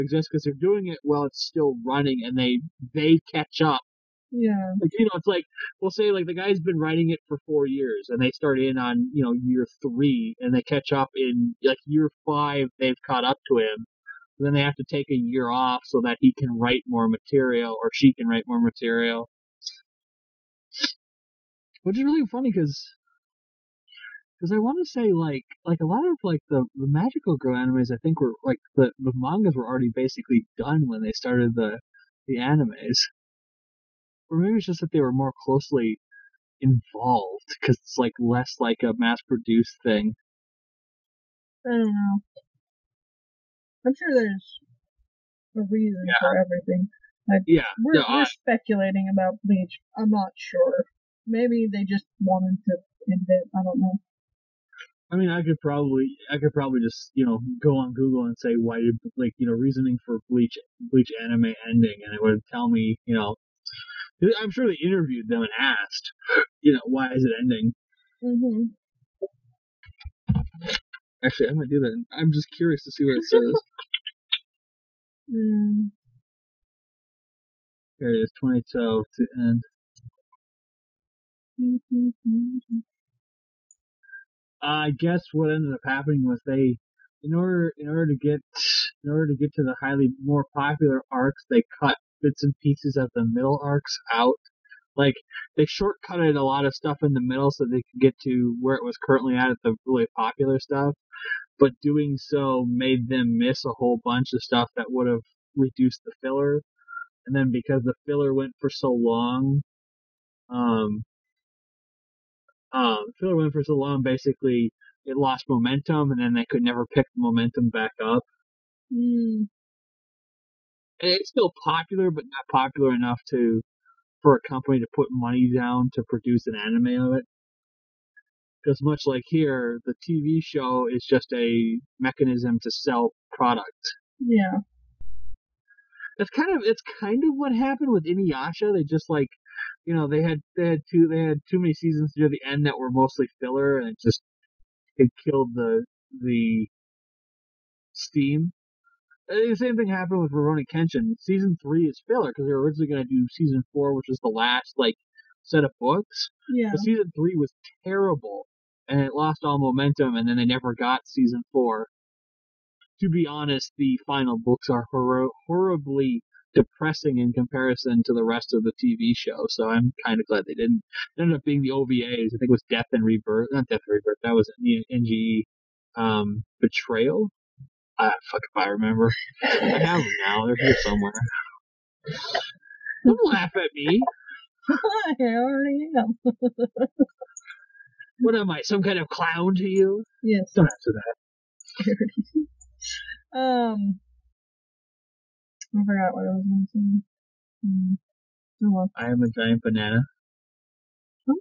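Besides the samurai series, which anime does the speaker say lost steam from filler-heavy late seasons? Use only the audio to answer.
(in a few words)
Inuyasha.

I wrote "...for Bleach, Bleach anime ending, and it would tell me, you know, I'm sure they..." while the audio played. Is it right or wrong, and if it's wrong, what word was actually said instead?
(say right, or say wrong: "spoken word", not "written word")
right.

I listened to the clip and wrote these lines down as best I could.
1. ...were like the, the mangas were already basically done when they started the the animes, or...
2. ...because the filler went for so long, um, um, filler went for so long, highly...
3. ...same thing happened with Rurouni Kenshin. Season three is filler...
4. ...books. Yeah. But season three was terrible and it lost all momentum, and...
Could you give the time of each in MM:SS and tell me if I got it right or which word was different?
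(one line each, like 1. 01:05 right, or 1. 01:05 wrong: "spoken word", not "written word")
1. 00:28 right
2. 01:47 wrong: "basically", not "highly"
3. 02:29 right
4. 02:35 right.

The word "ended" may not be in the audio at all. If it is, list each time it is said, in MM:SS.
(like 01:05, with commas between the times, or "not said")
01:25, 02:51.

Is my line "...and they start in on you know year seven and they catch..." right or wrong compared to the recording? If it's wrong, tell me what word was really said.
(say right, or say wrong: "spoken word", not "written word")
wrong: "three", not "seven".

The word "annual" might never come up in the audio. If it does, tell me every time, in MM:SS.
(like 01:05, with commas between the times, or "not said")
not said.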